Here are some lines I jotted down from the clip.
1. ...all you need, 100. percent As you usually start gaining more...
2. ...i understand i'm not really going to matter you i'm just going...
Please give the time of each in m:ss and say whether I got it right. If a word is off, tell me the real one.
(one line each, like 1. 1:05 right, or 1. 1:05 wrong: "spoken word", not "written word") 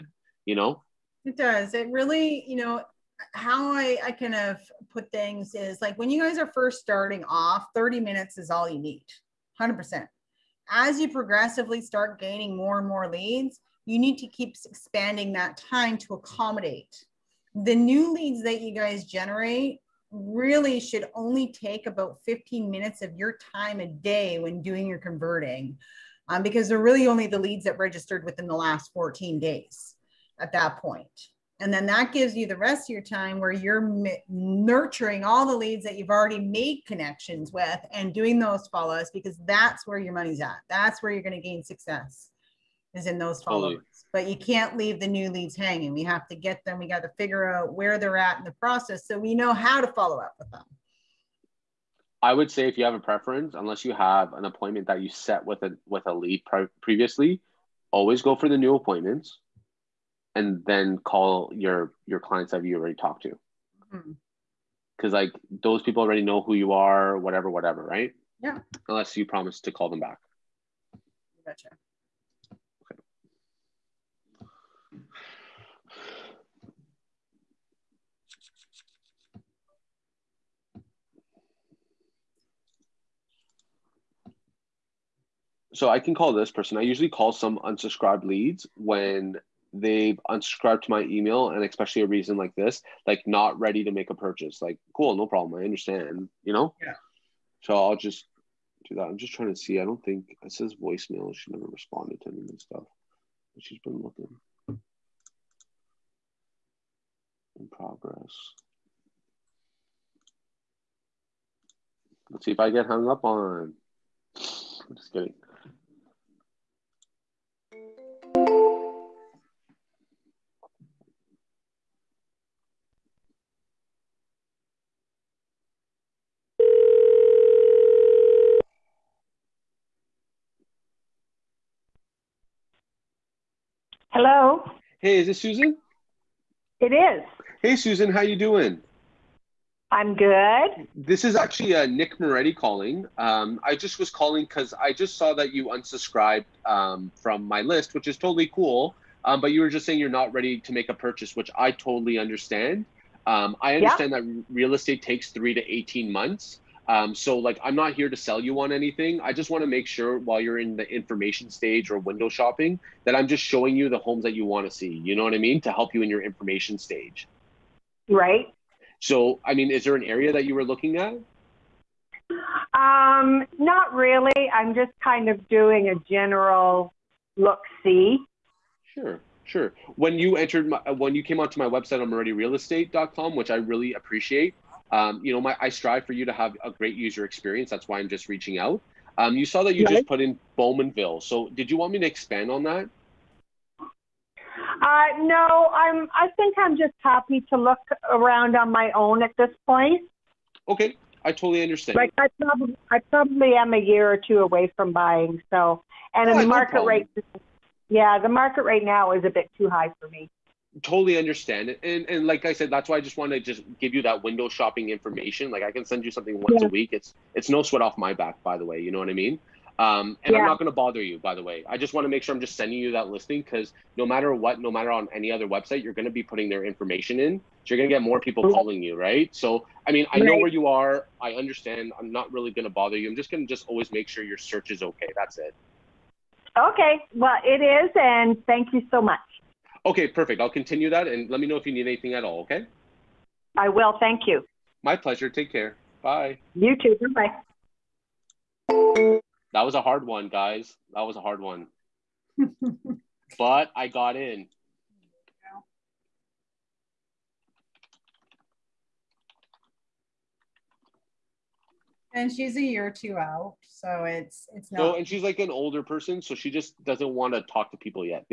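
1. 0:08 wrong: "progressively", not "usually"
2. 3:51 wrong: "bother", not "matter".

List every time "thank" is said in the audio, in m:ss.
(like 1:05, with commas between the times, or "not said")
3:58, 4:03.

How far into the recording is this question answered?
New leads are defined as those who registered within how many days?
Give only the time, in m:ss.
0:28.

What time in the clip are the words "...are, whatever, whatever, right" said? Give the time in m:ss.
1:06.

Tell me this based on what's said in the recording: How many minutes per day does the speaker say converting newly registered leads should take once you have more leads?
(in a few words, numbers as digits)
15 minutes.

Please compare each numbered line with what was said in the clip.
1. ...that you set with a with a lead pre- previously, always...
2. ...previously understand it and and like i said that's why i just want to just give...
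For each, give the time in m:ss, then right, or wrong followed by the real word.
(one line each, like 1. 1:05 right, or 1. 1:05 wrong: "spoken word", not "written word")
1. 0:54 right
2. 3:30 wrong: "totally", not "previously".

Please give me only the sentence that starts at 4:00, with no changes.
I'll continue that and let me know if you need anything at all, okay?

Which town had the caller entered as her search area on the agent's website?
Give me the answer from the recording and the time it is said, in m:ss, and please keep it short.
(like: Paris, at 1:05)
Bowmanville, at 3:10.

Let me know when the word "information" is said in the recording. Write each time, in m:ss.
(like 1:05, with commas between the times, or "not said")
2:40, 2:46, 3:34, 3:46.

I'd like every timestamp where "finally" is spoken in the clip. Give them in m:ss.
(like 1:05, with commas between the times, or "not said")
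not said.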